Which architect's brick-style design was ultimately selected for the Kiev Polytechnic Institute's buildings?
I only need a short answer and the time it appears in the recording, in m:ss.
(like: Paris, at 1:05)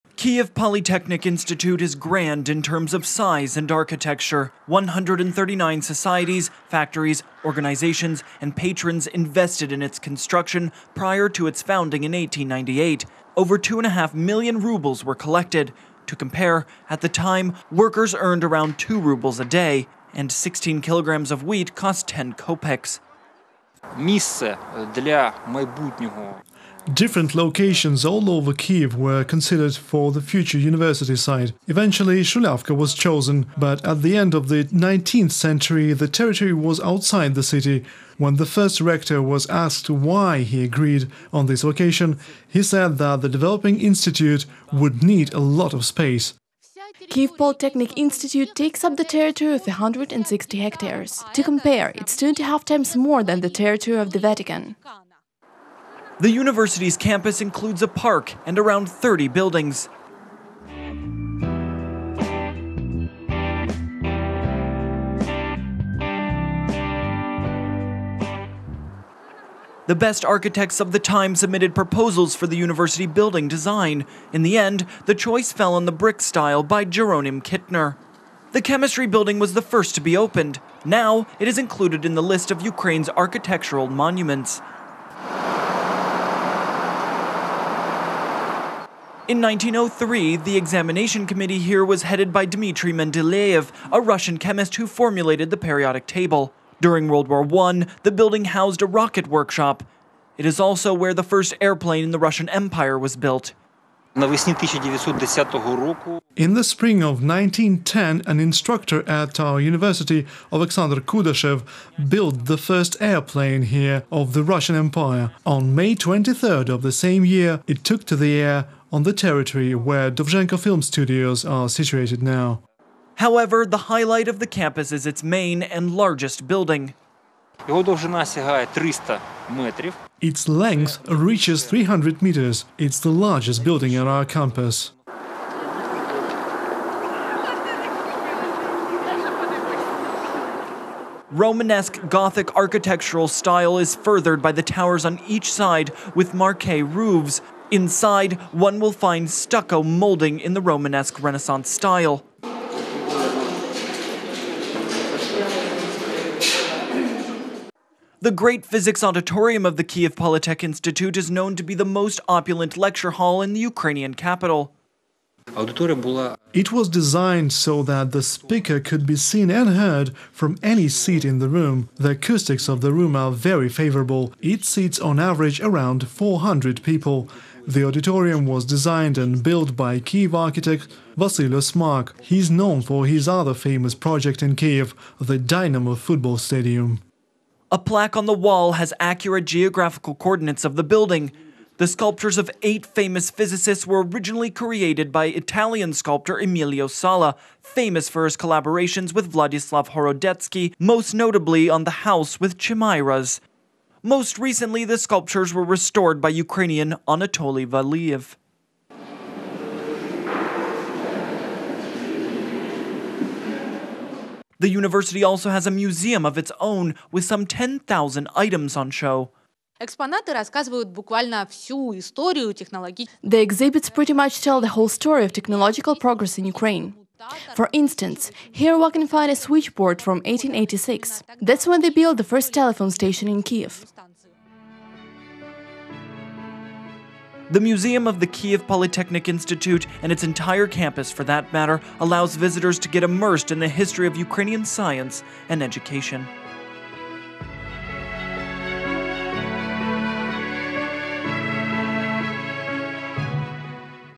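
Jeronim Kitner, at 1:16.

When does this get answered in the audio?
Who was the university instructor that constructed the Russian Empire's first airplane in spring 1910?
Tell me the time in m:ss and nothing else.
1:50.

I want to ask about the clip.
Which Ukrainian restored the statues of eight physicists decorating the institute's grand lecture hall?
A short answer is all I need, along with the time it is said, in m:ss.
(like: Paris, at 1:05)
Anatoly Valiev, at 3:27.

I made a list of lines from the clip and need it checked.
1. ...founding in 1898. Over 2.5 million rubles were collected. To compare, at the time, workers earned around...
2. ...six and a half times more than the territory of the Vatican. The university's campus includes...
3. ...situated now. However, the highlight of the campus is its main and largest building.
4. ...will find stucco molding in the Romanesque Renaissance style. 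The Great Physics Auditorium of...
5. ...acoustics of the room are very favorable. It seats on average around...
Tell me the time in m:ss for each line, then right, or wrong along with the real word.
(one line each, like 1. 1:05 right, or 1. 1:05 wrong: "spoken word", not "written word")
1. 0:11 right
2. 0:52 wrong: "two", not "six"
3. 2:01 right
4. 2:28 right
5. 2:52 right.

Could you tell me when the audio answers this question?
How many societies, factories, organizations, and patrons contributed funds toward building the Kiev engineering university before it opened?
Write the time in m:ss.
0:04.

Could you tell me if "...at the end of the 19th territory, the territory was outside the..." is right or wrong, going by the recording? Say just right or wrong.
wrong.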